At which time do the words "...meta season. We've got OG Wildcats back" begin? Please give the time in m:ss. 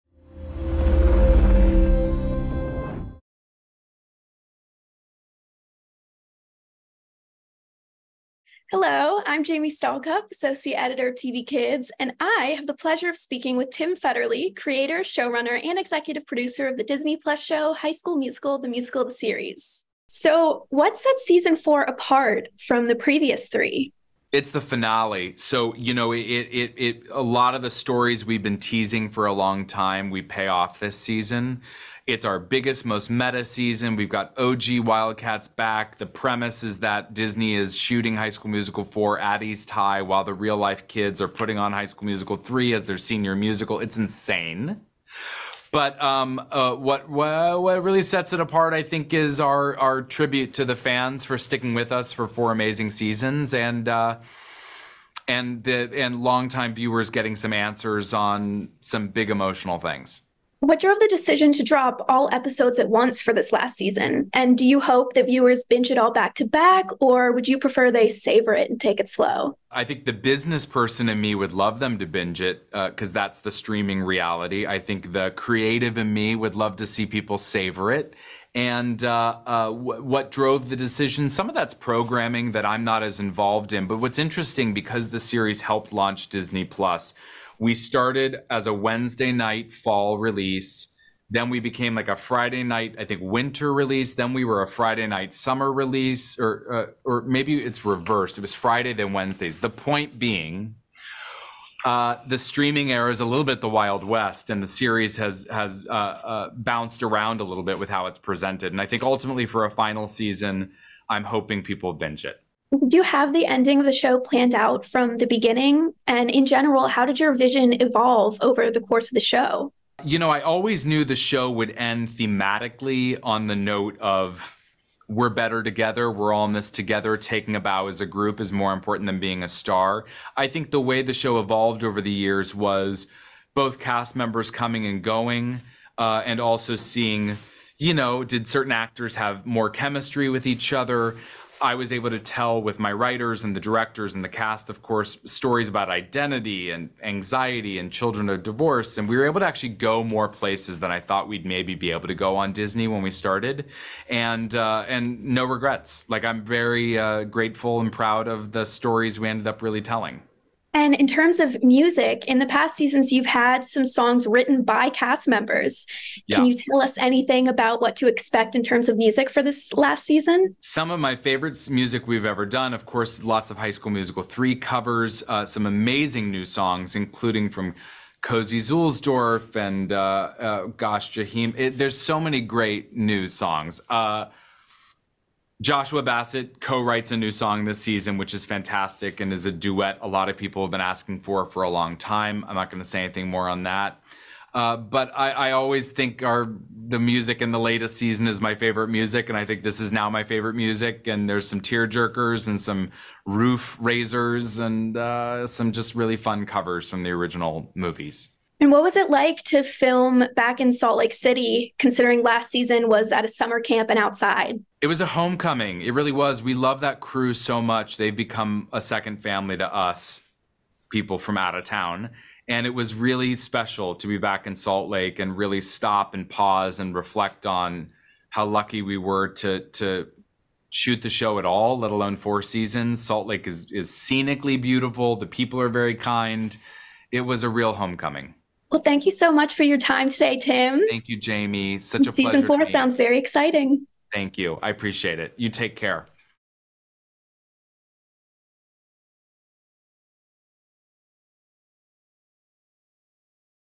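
0:33.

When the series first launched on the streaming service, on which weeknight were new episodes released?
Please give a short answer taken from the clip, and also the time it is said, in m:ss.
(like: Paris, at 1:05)
Wednesday, at 1:28.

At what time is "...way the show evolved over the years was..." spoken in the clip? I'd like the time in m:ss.
2:10.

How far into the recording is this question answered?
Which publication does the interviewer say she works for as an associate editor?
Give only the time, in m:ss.
0:11.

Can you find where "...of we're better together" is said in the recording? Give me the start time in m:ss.
2:03.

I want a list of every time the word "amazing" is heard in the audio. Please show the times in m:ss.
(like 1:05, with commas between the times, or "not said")
0:52, 2:55.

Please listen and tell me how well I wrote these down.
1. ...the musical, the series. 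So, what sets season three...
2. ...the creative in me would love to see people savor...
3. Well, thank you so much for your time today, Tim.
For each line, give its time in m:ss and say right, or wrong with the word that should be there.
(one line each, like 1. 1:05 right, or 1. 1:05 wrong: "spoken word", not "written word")
1. 0:18 wrong: "four", not "three"
2. 1:15 right
3. 3:58 right.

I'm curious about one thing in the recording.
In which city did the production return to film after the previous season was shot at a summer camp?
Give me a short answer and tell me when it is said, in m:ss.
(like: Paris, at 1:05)
Salt Lake City, at 3:30.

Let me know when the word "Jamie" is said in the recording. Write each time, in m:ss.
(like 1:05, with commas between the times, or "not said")
0:09, 4:01.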